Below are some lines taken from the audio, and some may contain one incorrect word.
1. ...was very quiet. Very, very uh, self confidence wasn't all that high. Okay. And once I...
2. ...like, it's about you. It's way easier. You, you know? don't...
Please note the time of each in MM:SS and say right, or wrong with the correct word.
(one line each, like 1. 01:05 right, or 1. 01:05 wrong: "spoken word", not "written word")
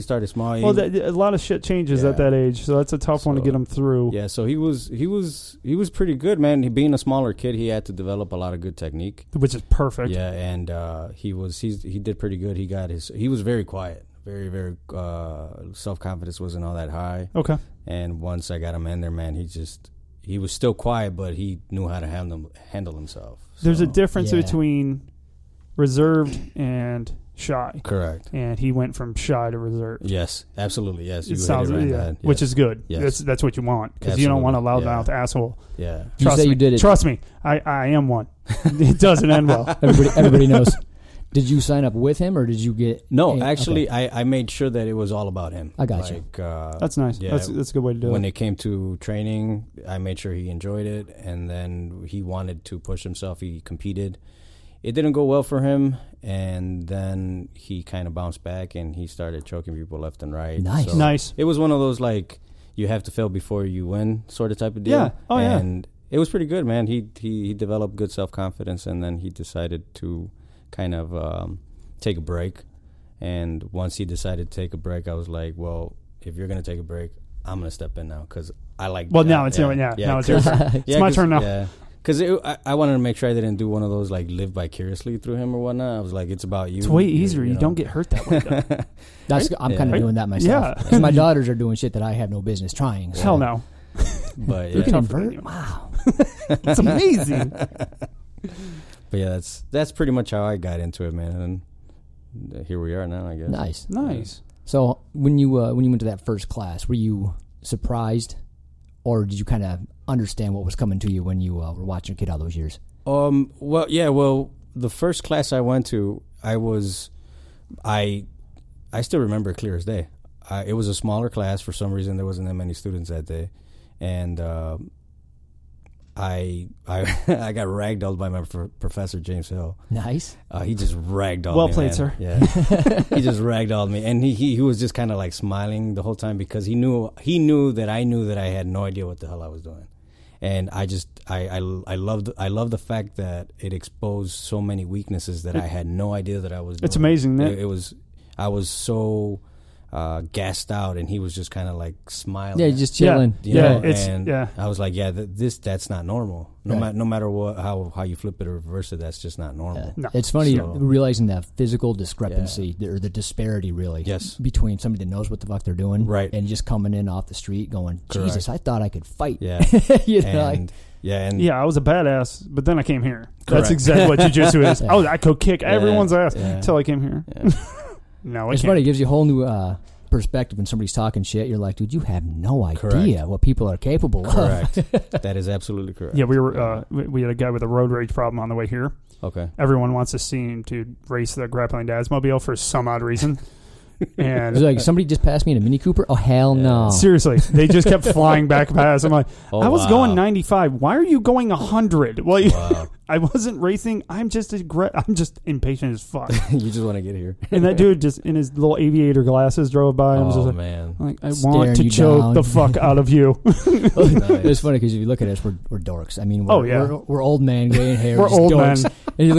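1. 00:13 right
2. 01:26 right.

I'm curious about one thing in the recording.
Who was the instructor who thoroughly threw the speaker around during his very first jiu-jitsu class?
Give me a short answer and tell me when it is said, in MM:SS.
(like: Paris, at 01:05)
James Hill, at 02:09.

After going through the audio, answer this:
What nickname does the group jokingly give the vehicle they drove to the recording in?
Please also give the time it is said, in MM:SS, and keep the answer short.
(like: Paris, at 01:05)
grappling dad's mobile, at 03:11.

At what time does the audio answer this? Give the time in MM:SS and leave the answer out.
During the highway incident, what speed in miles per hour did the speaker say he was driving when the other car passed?
03:20.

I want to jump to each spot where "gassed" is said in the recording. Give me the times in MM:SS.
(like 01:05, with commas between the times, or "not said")
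02:30.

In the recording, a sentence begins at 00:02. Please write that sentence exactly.
at that age, so that's a tough so, one to get him through.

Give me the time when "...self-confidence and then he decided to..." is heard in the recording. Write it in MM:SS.
01:08.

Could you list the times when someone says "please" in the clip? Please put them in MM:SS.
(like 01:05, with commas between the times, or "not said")
not said.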